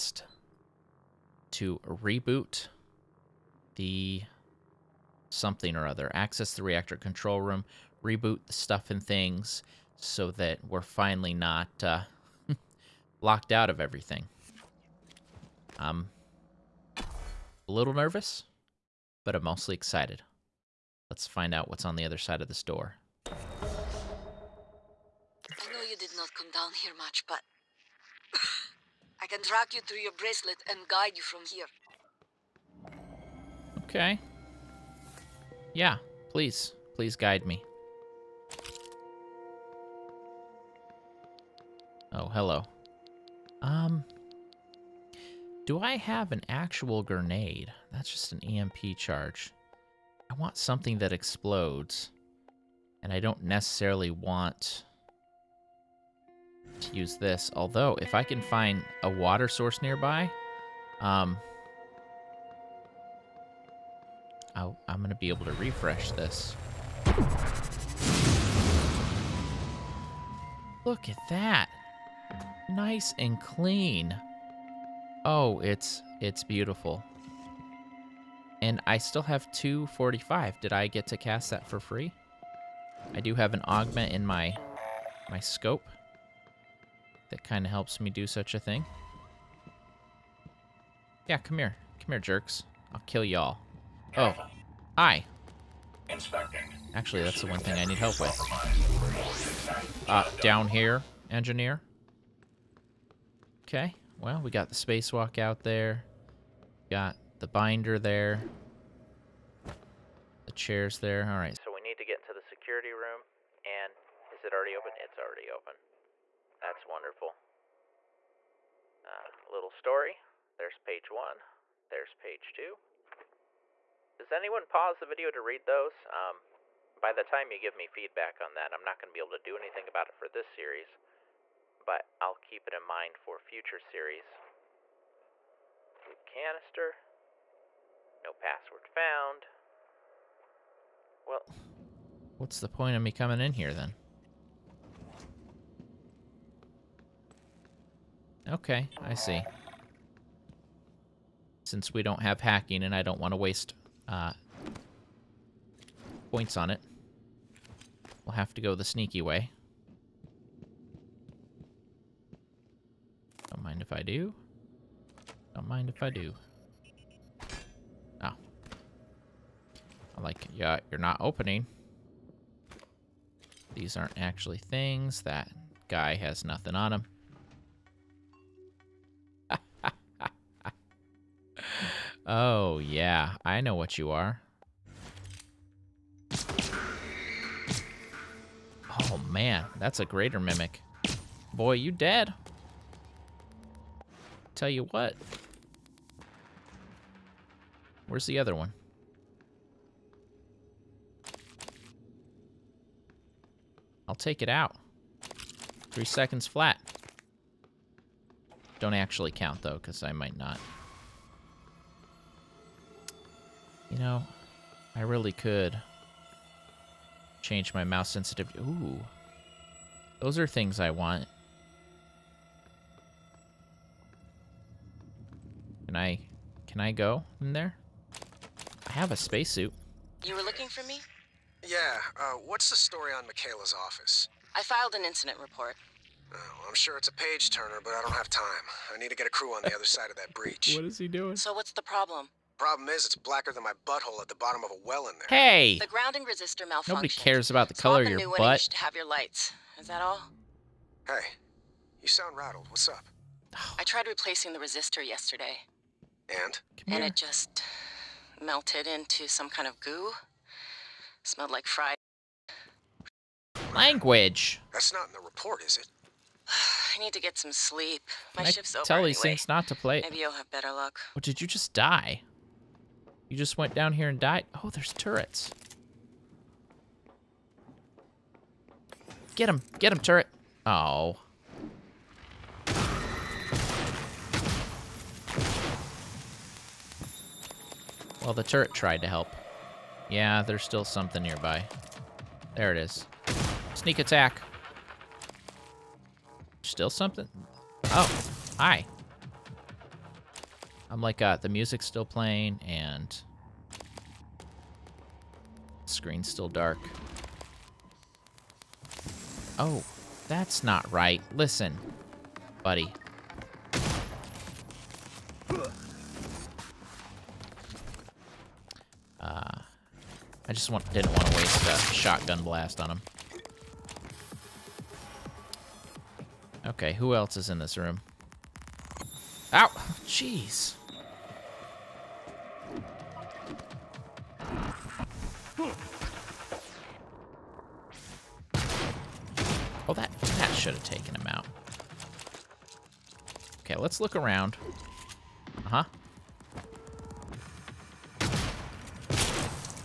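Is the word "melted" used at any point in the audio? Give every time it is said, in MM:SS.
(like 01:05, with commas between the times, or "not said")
04:18.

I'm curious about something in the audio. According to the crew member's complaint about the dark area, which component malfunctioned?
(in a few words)
grounding resistor.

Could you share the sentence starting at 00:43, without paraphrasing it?
Um, do I have an actual grenade?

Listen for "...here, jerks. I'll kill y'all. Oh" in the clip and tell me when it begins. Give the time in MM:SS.
01:32.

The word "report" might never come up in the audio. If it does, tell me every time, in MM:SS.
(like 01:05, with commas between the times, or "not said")
03:55, 04:25.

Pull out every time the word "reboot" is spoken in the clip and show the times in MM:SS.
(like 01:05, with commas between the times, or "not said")
00:01, 00:08.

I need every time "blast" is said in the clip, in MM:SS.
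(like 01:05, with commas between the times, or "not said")
05:22.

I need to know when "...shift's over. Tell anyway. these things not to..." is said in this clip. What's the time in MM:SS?
04:28.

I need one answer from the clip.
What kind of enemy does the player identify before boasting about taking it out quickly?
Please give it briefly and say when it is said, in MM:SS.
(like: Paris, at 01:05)
greater mimic, at 03:10.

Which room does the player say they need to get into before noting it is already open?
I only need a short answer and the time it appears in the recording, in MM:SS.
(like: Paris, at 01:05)
security room, at 01:52.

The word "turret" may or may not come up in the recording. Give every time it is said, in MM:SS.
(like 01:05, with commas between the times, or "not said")
04:34, 04:39, 04:48.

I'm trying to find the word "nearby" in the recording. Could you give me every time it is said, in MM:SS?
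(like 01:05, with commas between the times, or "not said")
00:59, 04:51.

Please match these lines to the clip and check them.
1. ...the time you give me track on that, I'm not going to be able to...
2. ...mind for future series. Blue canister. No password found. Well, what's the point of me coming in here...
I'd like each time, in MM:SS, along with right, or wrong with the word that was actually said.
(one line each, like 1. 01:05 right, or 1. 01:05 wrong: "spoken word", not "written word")
1. 02:07 wrong: "feedback", not "track"
2. 02:12 right.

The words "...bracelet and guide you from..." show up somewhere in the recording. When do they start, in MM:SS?
00:30.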